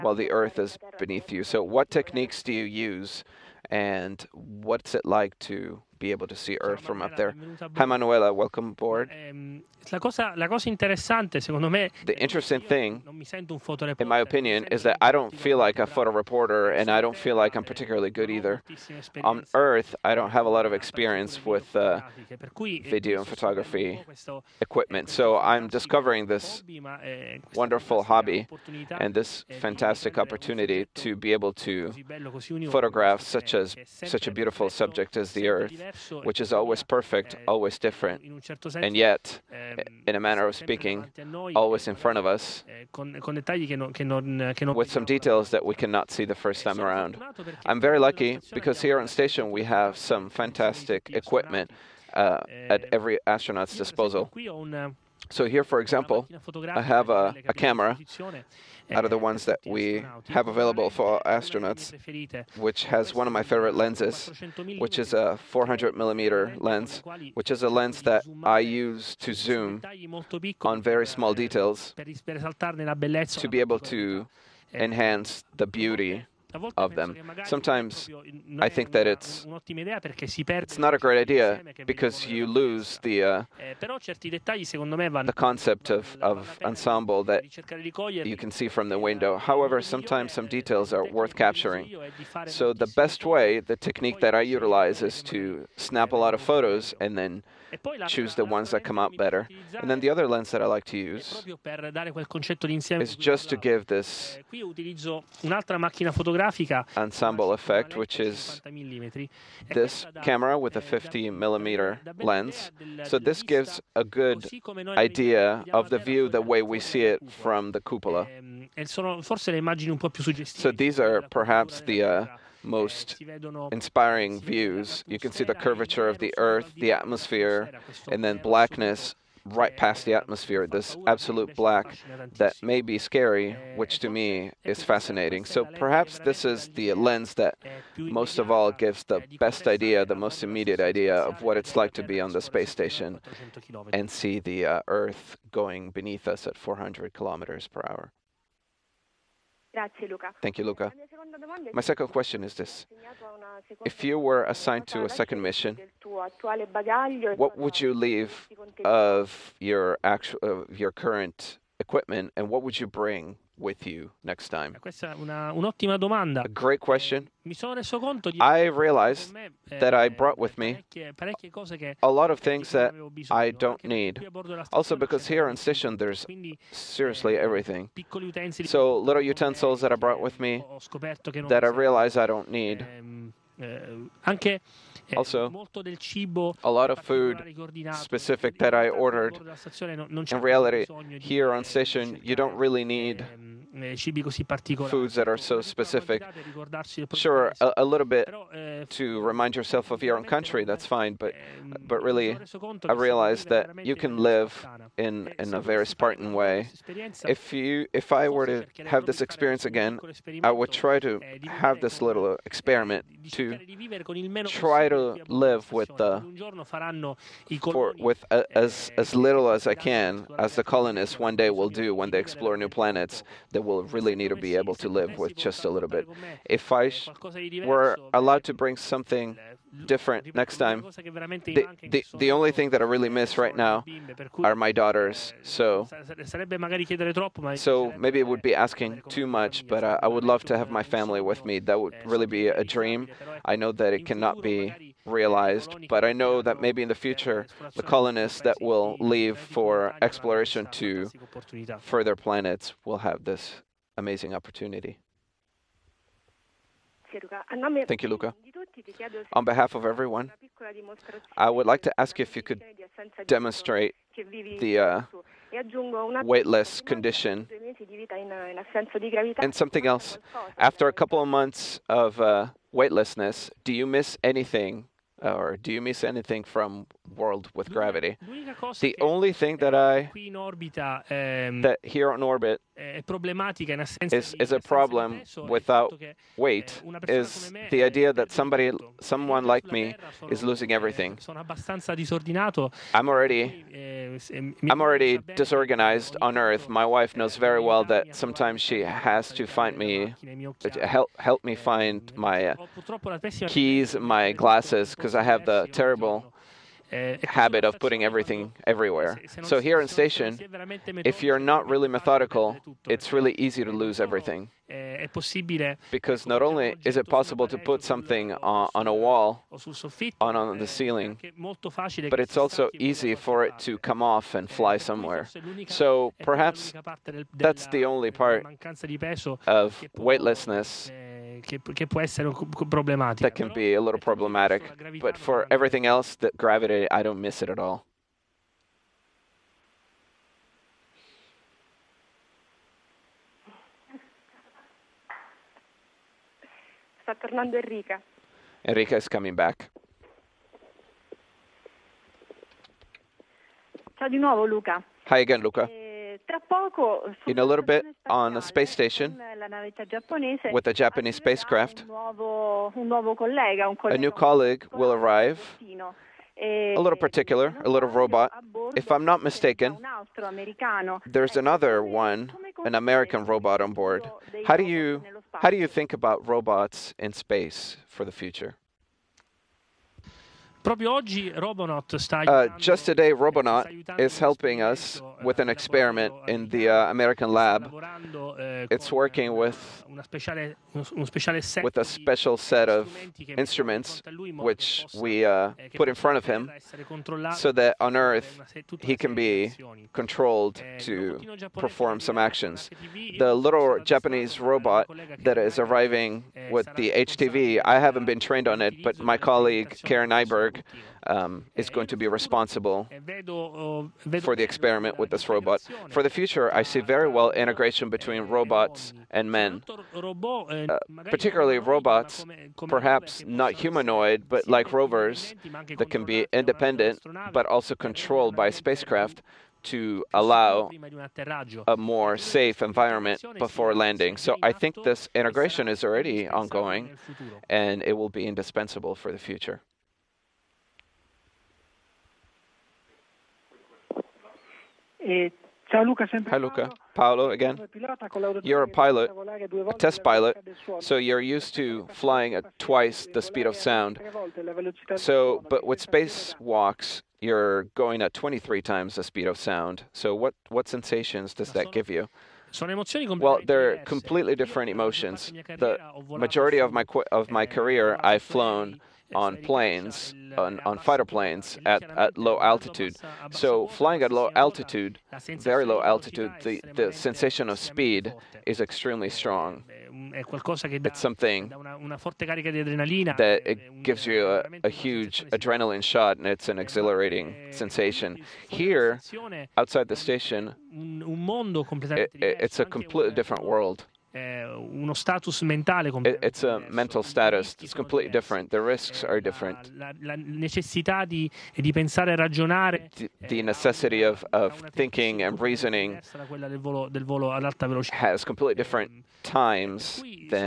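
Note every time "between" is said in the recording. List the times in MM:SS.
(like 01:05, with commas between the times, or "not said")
06:57.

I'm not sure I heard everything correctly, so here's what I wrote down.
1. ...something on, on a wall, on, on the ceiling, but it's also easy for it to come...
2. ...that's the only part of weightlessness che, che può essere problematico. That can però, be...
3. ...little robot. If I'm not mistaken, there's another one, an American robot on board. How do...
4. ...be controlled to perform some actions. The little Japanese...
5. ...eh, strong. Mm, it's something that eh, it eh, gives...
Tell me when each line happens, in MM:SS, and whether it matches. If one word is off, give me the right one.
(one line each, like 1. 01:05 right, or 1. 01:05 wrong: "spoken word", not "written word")
1. 05:17 right
2. 05:27 right
3. 06:07 right
4. 06:39 right
5. 07:59 right.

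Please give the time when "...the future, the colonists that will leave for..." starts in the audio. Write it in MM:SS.
04:06.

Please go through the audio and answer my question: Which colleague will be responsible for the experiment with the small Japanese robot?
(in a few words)
Karen Nyberg.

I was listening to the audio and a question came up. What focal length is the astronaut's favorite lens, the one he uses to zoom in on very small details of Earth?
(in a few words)
400 millimeter.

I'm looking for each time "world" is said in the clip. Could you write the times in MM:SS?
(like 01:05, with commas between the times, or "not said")
04:37, 08:13.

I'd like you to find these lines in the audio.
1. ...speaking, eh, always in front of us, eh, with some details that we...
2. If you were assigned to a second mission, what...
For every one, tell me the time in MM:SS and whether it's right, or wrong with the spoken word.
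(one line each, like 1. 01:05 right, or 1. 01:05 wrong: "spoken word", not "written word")
1. 00:40 right
2. 02:33 right.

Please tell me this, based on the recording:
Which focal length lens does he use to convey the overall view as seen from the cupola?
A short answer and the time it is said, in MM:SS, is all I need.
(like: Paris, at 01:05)
50 millimeter, at 01:50.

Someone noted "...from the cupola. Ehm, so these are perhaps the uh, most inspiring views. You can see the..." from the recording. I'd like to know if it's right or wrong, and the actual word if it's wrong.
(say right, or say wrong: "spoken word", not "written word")
right.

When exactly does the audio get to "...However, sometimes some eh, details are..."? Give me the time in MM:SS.
01:29.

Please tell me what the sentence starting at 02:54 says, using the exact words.
Also, because here on station there's seriously everything.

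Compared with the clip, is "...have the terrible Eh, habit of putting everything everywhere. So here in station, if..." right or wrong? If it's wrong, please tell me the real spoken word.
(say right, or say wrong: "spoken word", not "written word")
right.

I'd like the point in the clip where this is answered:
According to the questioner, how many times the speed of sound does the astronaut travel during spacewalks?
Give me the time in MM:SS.
07:38.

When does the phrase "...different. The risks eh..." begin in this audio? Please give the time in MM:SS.
08:18.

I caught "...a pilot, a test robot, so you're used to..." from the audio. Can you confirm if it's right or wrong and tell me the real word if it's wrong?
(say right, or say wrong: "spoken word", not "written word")
wrong: "pilot", not "robot".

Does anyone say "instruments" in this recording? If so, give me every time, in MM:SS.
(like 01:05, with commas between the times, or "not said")
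06:33.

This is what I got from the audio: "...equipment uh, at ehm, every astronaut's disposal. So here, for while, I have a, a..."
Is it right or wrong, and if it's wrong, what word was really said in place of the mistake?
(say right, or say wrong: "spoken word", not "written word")
wrong: "example", not "while".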